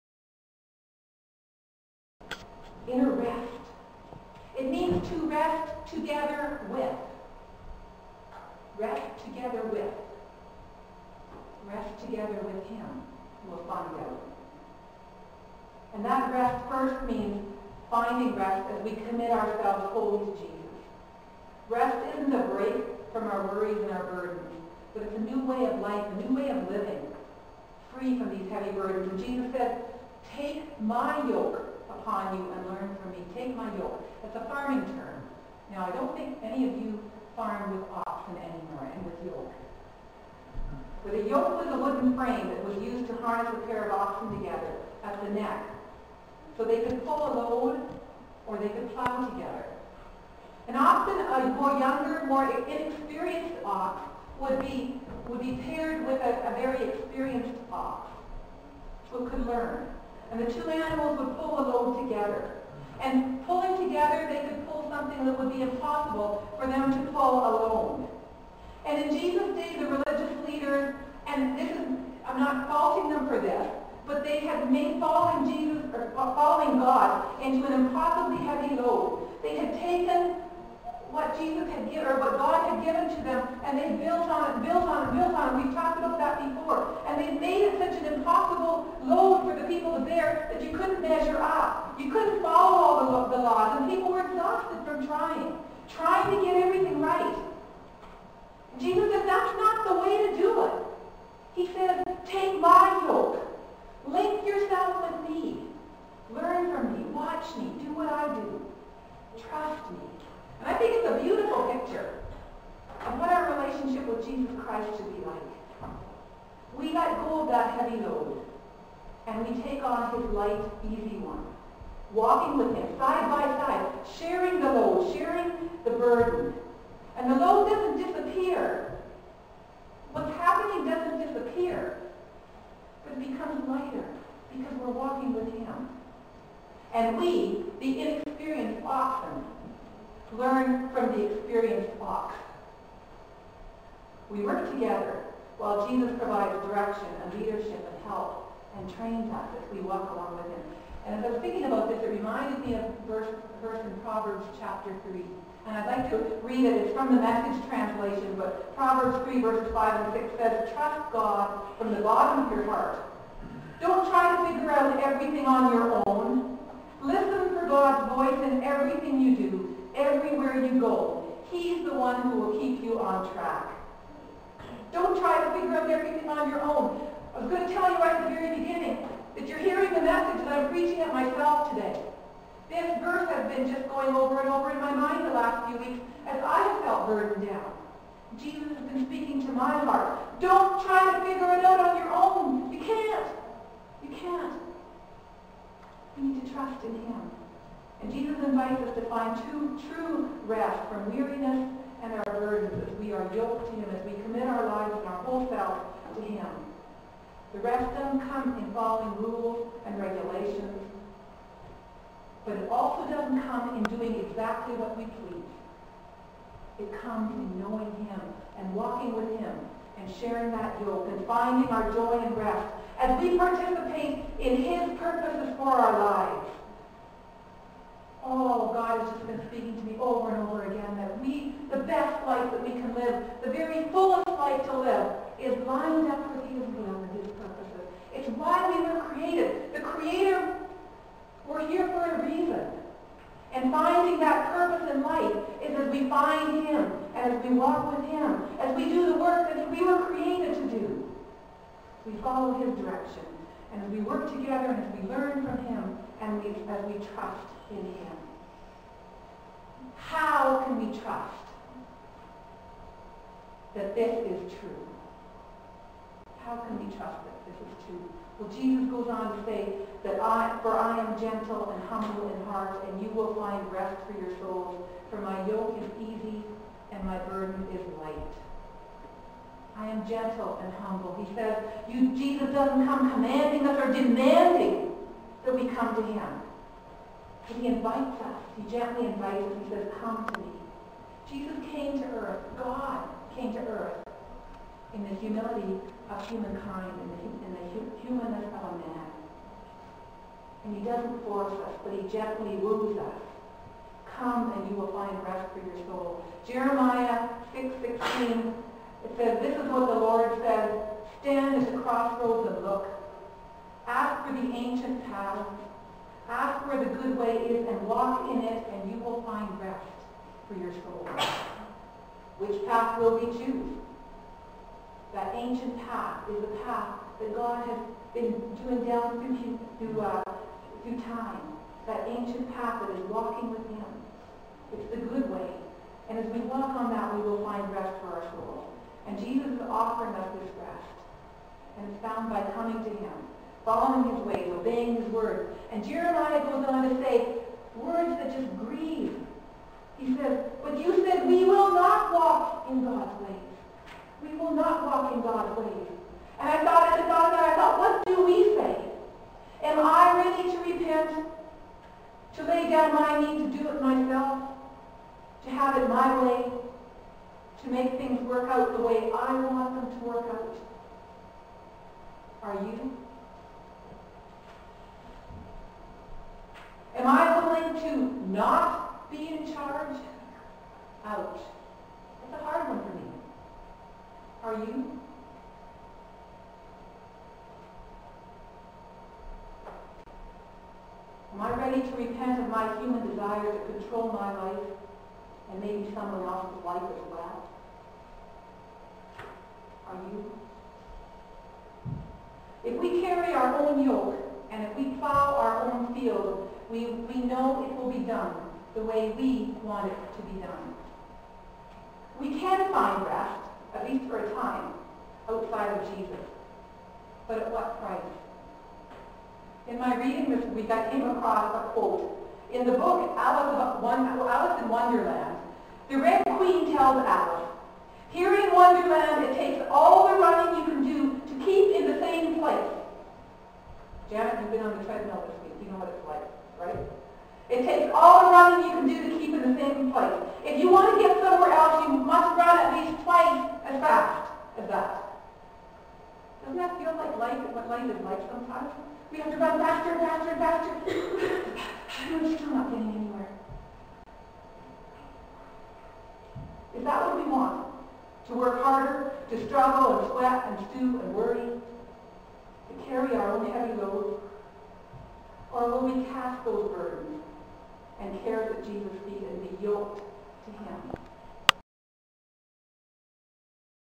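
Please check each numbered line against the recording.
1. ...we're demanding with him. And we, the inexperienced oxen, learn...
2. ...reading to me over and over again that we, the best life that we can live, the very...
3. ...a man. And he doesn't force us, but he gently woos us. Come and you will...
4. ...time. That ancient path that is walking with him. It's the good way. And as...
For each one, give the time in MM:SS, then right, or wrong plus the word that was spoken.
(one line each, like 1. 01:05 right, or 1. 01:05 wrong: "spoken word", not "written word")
1. 02:14 wrong: "walking", not "demanding"
2. 03:49 wrong: "speaking", not "reading"
3. 04:58 right
4. 05:31 right.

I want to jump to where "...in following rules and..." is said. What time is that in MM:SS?
03:28.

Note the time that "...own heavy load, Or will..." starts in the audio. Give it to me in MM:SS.
07:43.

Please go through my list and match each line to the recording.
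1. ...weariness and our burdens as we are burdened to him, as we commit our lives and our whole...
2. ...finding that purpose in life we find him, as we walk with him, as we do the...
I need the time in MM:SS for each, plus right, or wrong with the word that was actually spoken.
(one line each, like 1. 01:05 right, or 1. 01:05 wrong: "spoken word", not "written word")
1. 03:21 wrong: "yoked", not "burdened"
2. 04:03 right.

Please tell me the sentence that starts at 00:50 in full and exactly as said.
And often a more younger, more inexperienced ox would be, would be paired with a, a very experienced ox who could learn.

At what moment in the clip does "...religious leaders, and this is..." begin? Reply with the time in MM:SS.
01:09.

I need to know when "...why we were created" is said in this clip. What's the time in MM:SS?
03:58.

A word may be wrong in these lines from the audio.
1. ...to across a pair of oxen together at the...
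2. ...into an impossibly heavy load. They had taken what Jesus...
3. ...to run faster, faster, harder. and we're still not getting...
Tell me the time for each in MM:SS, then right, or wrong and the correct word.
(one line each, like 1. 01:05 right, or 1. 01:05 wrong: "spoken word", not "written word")
1. 00:43 wrong: "harness", not "across"
2. 01:17 right
3. 07:29 wrong: "faster", not "harder".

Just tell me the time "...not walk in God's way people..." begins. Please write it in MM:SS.
05:51.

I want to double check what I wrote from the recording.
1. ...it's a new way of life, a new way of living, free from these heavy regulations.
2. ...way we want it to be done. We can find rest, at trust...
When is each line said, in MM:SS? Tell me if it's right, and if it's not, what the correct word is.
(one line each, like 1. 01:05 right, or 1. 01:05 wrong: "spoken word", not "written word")
1. 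00:25 wrong: "burdens", not "regulations"
2. 06:48 wrong: "least", not "trust".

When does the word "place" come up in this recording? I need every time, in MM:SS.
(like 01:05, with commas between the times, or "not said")
07:12, 07:19.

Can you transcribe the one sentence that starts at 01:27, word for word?
And they made it such an impossible people there that you couldn't measure up.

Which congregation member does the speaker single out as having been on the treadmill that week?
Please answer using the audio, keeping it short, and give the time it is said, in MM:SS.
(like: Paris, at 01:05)
Janet, at 07:14.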